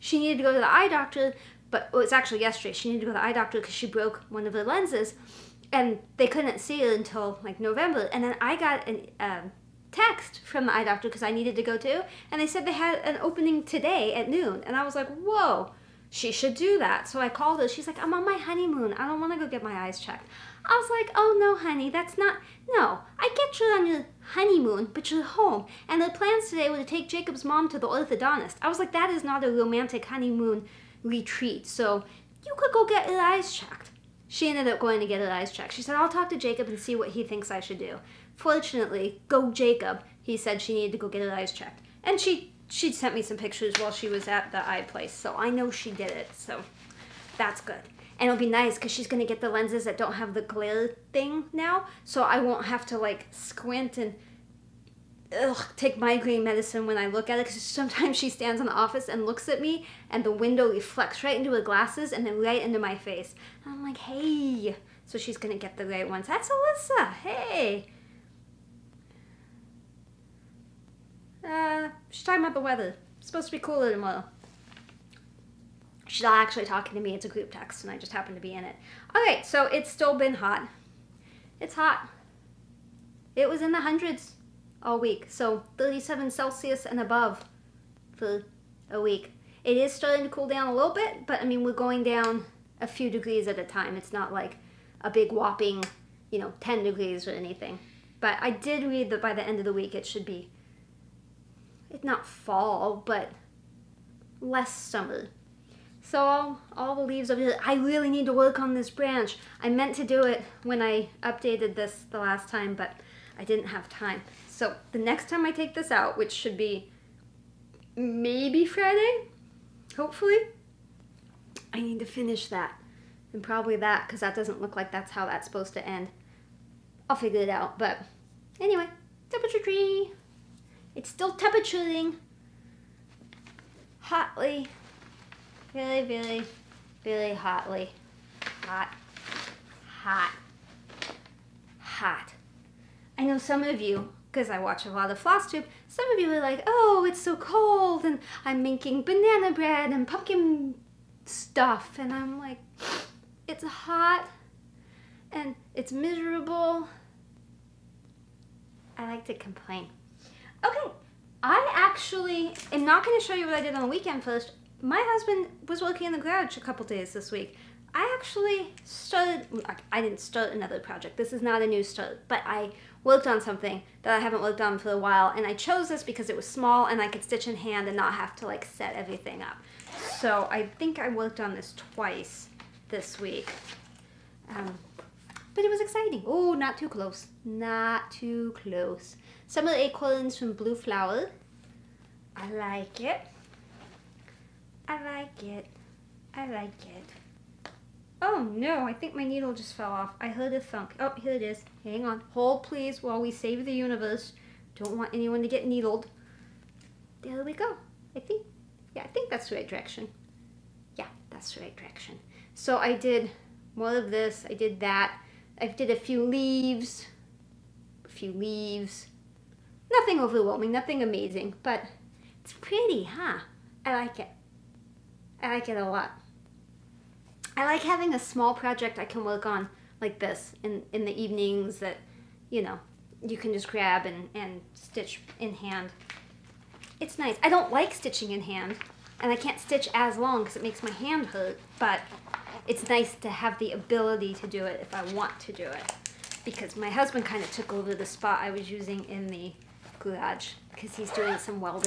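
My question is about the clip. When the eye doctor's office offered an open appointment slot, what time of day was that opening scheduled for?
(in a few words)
noon.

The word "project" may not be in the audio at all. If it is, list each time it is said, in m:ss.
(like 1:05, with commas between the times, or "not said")
2:50, 3:48.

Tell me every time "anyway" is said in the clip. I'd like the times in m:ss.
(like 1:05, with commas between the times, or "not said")
2:08.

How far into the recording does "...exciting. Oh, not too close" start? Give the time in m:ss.
3:05.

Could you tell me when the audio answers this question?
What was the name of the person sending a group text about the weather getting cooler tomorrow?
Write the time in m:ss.
1:06.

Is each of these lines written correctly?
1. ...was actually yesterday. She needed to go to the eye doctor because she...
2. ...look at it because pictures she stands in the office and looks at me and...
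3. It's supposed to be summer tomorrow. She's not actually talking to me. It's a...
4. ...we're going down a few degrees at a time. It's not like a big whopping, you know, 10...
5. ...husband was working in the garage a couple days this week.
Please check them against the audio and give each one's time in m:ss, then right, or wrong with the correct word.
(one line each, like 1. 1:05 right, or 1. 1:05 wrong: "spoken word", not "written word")
1. 0:02 right
2. 0:57 wrong: "sometimes", not "pictures"
3. 1:13 wrong: "cooler", not "summer"
4. 1:31 right
5. 2:45 right.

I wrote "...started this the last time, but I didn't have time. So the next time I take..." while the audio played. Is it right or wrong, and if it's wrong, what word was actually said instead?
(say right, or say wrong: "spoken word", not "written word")
wrong: "updated", not "started".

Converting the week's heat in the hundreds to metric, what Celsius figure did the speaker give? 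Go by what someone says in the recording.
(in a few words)
37 Celsius.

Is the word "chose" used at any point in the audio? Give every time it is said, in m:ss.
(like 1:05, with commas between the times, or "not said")
2:55.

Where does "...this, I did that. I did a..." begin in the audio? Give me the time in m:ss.
3:34.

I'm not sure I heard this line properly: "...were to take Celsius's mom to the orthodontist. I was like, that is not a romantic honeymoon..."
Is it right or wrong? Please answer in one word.
wrong.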